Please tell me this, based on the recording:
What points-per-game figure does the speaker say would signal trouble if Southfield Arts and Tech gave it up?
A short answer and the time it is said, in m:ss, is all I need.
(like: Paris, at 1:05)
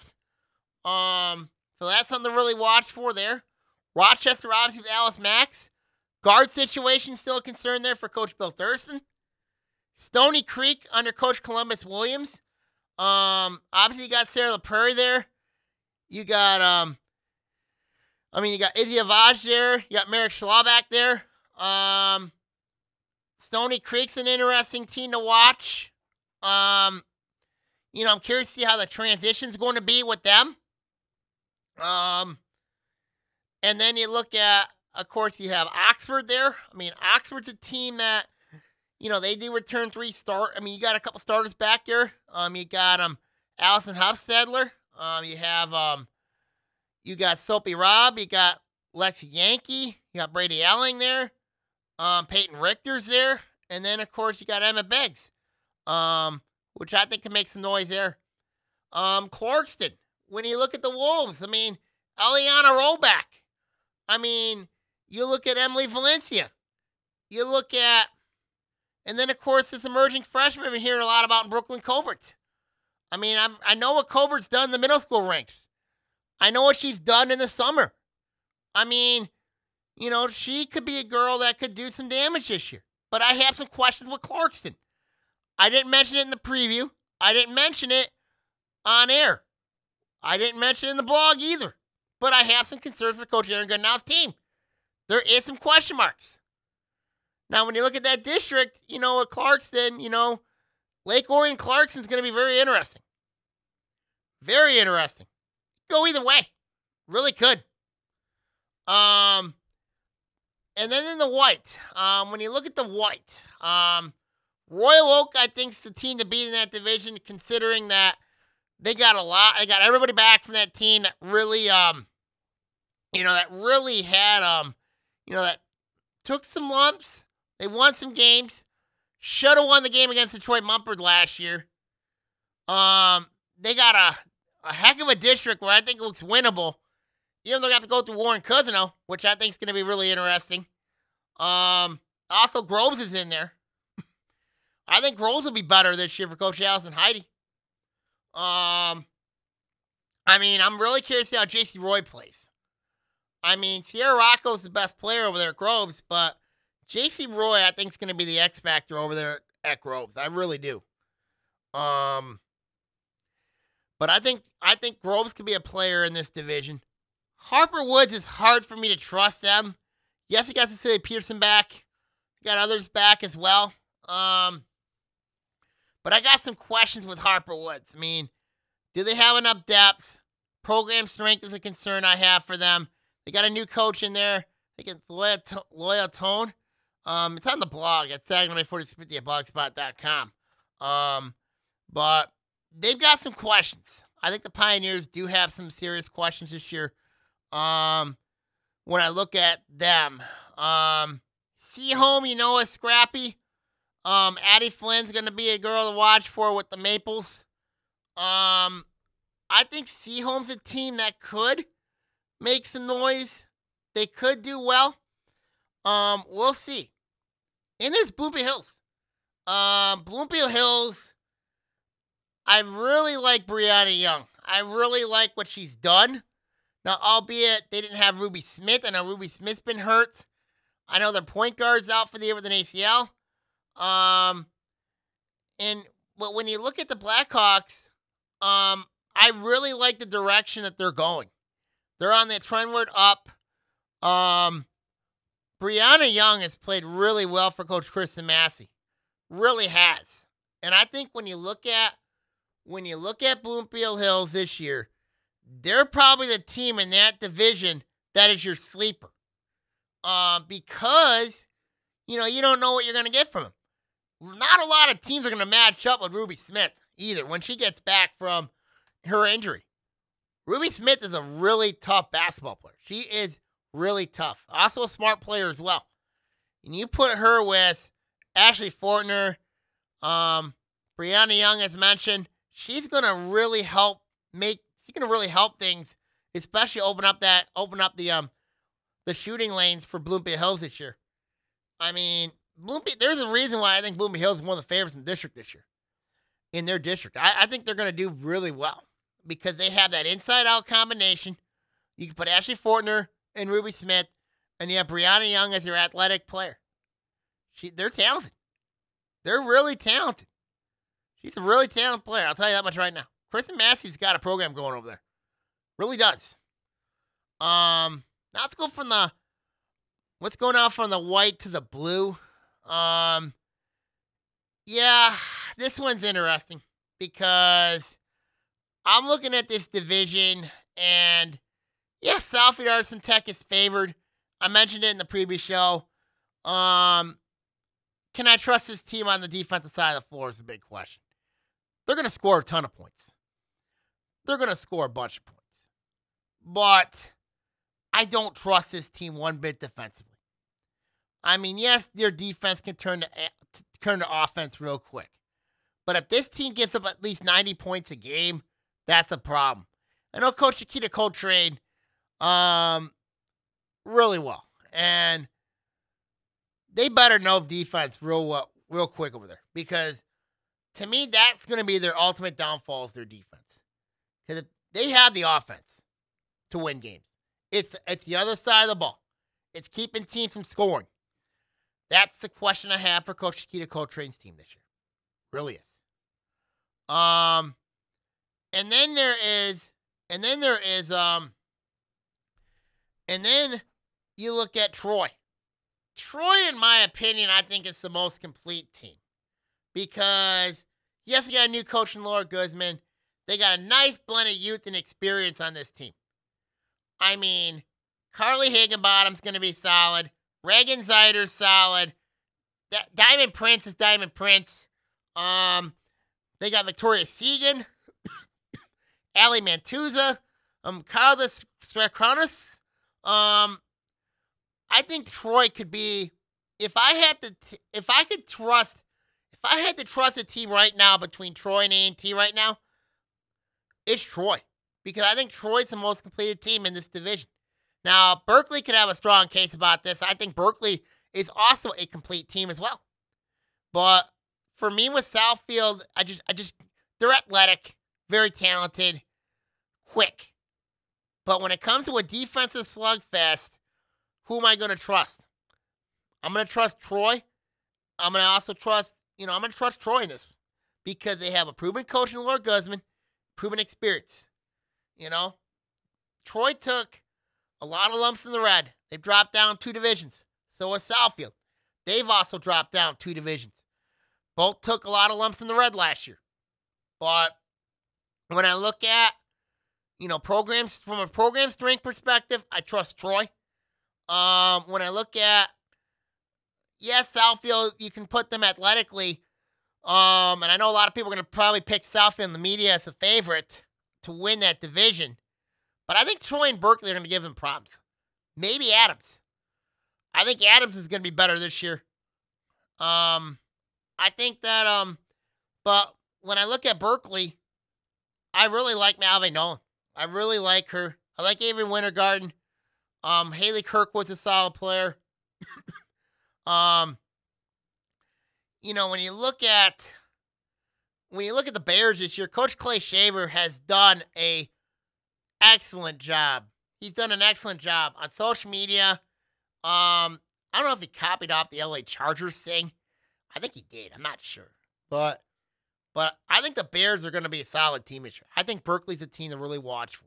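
90, at 5:57.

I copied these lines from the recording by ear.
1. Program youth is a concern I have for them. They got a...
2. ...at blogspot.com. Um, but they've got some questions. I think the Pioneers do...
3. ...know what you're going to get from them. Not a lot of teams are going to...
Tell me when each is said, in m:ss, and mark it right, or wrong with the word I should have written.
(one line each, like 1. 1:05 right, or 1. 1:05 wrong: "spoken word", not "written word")
1. 3:00 wrong: "strength", not "youth"
2. 3:09 right
3. 4:22 right.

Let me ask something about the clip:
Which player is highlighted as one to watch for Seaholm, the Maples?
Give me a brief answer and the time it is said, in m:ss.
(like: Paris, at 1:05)
Addie Flynn, at 3:24.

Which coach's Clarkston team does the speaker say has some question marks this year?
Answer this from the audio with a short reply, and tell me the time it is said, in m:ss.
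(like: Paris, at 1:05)
Aaron Goodenow, at 1:33.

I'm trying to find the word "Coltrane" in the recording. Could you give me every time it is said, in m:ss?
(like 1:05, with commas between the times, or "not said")
6:00, 6:23.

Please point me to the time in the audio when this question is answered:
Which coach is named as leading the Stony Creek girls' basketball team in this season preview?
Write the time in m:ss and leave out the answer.
0:11.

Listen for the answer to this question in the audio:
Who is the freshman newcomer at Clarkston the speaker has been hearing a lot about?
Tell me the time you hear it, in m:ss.
1:11.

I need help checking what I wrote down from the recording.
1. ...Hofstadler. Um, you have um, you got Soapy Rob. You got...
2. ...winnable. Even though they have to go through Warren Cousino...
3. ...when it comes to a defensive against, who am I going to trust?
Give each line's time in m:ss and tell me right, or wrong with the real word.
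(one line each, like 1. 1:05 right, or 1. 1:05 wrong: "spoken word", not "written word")
1. 0:43 right
2. 2:16 right
3. 7:31 wrong: "slugfest", not "against".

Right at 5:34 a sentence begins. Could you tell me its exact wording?
I mentioned it in the previous show.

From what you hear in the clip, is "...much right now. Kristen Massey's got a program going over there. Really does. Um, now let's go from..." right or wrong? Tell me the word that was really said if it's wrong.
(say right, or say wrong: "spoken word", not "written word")
right.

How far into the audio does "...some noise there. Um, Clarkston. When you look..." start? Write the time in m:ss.
0:57.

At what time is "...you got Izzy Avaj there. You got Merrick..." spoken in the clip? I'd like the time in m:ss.
0:18.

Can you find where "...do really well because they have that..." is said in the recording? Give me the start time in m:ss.
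4:57.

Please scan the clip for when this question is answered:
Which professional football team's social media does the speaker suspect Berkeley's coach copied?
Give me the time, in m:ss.
8:51.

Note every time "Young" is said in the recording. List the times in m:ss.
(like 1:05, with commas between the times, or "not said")
3:43, 4:06, 4:41, 5:05.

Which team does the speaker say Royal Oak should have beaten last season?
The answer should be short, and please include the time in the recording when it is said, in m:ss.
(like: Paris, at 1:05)
Detroit Mumford, at 2:10.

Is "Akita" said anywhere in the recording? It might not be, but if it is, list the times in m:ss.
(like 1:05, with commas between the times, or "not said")
6:00, 6:23.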